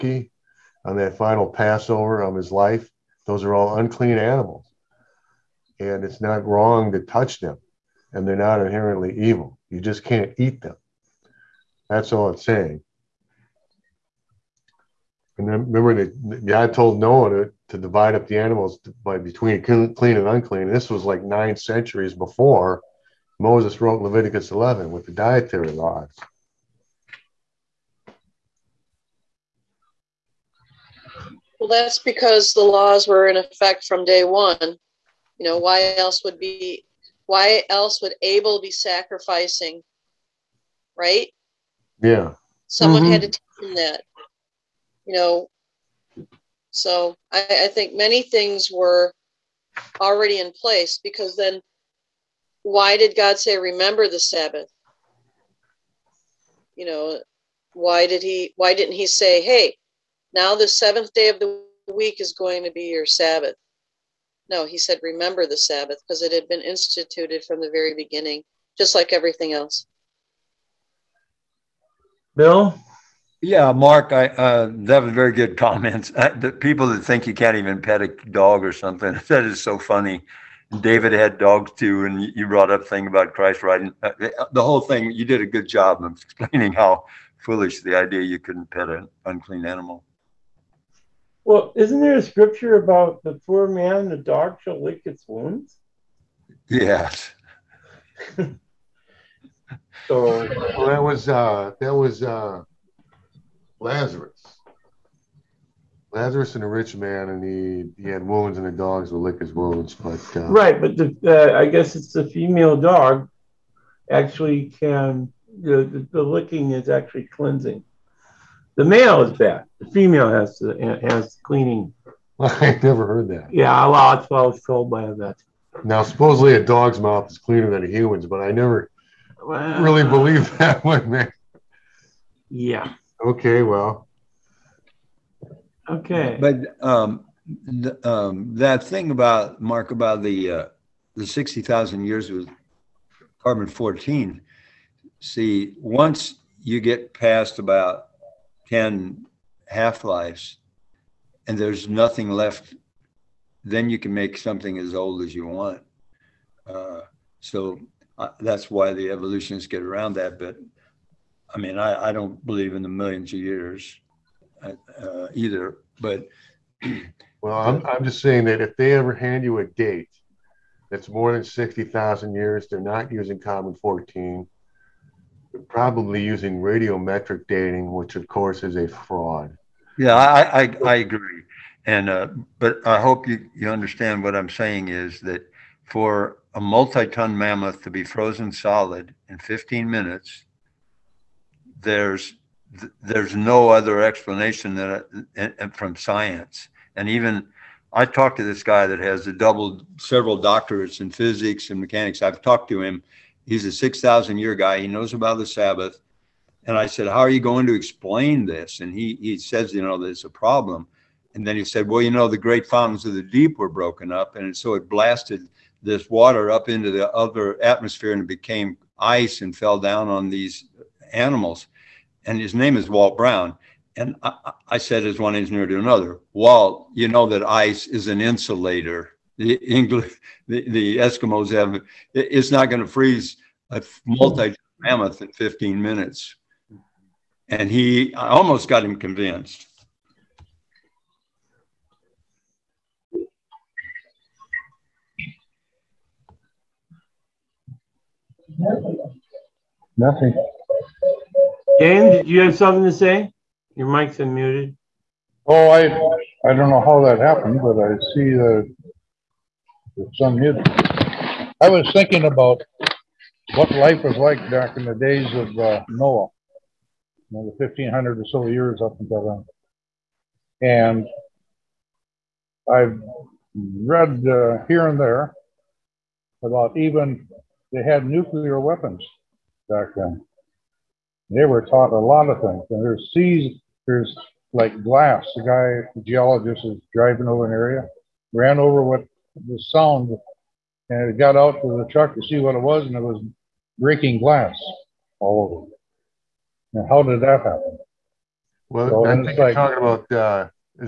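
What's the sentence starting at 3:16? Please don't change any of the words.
And even I talked to this guy that has a double, several doctorates in physics and mechanics.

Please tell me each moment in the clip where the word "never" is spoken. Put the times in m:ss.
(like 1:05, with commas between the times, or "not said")
2:02, 2:08.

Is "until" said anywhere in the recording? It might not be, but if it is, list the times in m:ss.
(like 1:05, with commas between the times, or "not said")
4:29.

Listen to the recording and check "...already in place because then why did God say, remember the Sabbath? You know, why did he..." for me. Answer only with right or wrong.
right.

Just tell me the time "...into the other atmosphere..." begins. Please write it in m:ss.
3:36.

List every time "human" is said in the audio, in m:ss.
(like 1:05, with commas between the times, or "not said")
2:07.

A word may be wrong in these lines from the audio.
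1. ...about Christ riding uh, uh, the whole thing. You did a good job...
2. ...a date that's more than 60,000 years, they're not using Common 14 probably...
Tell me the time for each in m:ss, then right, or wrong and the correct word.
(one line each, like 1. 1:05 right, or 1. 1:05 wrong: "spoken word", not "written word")
1. 1:23 right
2. 2:49 right.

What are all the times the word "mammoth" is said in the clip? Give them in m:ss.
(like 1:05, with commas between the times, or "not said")
3:07, 3:54.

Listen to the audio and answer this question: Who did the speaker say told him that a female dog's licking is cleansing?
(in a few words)
a vet.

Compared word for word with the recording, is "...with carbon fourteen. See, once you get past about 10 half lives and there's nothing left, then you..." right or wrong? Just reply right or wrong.
right.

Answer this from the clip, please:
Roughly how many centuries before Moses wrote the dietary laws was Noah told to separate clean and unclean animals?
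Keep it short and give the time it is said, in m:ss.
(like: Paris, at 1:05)
9, at 0:21.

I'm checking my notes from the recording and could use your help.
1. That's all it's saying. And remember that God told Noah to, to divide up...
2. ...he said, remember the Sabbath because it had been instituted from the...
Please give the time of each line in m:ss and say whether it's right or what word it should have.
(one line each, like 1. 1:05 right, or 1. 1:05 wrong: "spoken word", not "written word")
1. 0:11 right
2. 1:04 right.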